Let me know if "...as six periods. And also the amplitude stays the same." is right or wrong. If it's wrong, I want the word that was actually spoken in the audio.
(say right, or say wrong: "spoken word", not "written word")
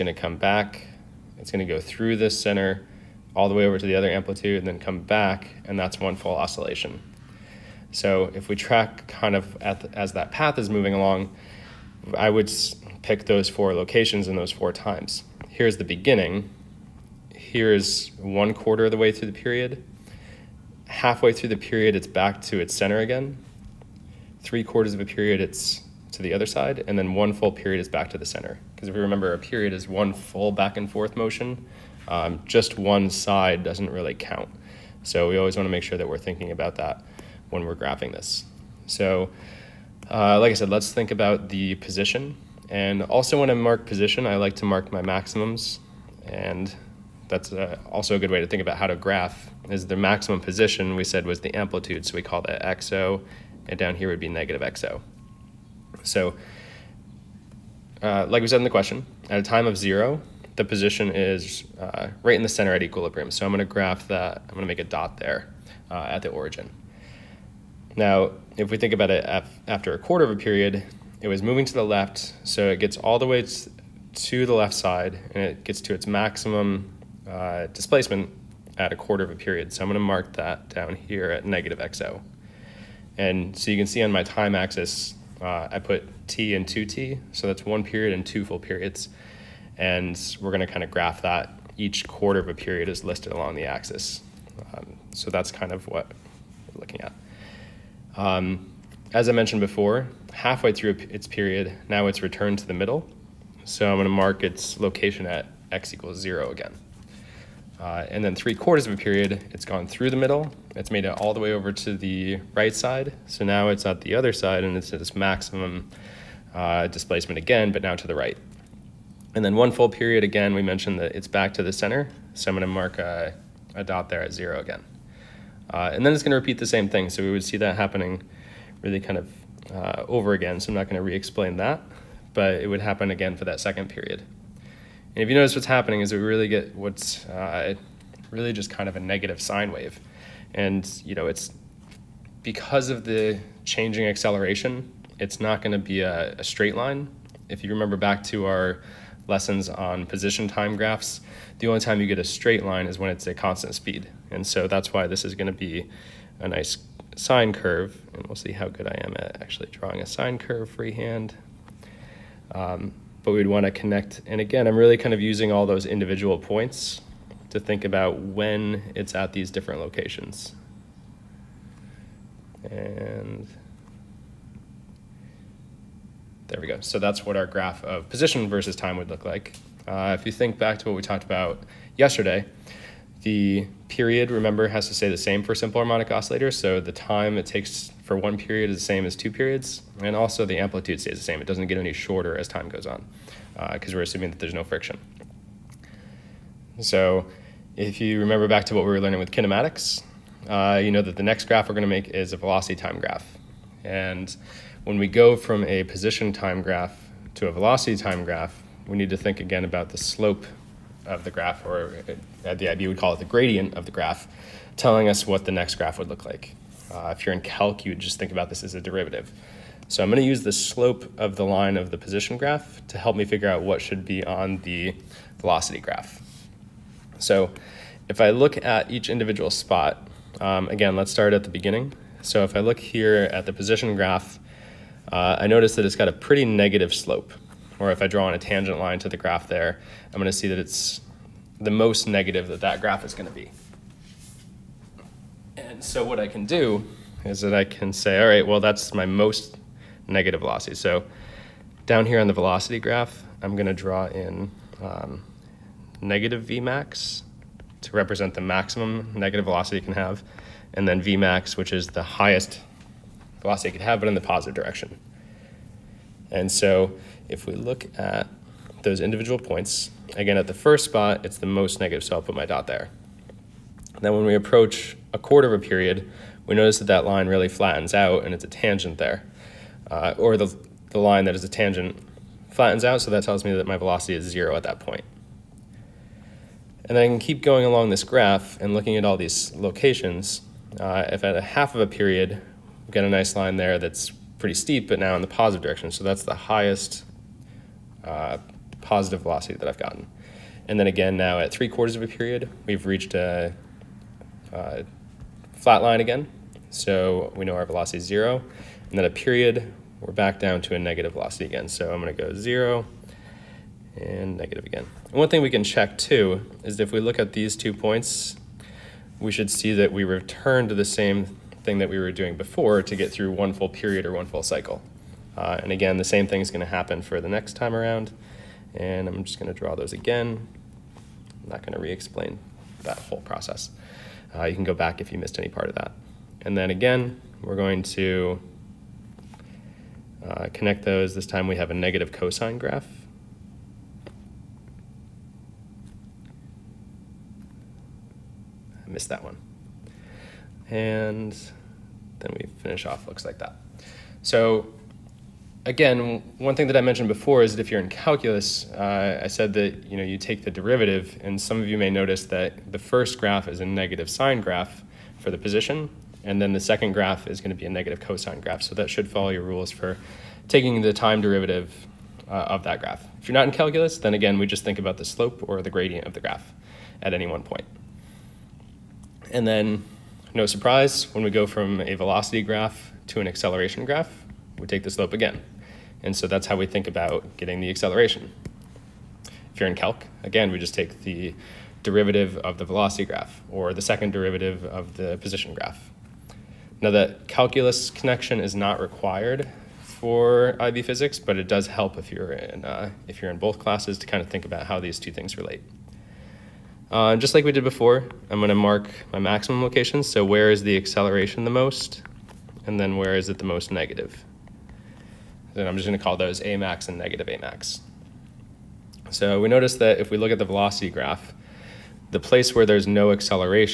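wrong: "two", not "six".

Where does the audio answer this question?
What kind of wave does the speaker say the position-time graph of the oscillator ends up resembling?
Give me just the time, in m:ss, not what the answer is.
2:18.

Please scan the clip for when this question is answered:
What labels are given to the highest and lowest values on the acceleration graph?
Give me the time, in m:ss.
6:56.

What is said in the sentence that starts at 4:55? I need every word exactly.
So that's the highest uh, positive velocity that I've gotten.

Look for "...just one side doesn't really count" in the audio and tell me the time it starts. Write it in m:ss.
0:32.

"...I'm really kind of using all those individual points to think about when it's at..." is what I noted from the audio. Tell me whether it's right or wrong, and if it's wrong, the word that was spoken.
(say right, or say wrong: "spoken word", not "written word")
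right.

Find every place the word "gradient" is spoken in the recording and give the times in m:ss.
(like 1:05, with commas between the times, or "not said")
3:33, 6:15.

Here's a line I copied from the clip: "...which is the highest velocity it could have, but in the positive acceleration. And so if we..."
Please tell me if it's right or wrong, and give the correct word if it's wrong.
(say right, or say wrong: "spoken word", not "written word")
wrong: "direction", not "acceleration".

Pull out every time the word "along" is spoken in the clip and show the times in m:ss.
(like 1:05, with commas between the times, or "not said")
0:10, 1:33, 4:47.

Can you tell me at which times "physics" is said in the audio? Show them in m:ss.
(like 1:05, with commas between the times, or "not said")
6:40.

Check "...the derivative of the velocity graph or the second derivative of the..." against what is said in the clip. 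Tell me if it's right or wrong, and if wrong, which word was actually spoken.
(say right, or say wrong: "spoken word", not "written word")
right.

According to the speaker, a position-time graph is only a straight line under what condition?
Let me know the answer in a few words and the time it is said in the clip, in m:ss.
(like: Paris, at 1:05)
constant speed, at 2:33.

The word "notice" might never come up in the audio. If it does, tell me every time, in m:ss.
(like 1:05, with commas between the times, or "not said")
2:15, 3:55, 4:36, 6:01, 6:59.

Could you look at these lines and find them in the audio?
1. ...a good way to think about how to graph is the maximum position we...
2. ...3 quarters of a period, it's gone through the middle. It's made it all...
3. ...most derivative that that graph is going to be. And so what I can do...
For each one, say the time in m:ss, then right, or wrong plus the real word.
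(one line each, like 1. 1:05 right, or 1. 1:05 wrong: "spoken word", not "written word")
1. 0:48 right
2. 1:48 right
3. 4:01 wrong: "negative", not "derivative".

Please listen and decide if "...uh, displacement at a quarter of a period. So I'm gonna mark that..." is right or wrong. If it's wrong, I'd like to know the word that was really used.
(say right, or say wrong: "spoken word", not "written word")
right.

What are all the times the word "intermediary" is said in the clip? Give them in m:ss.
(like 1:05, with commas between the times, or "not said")
not said.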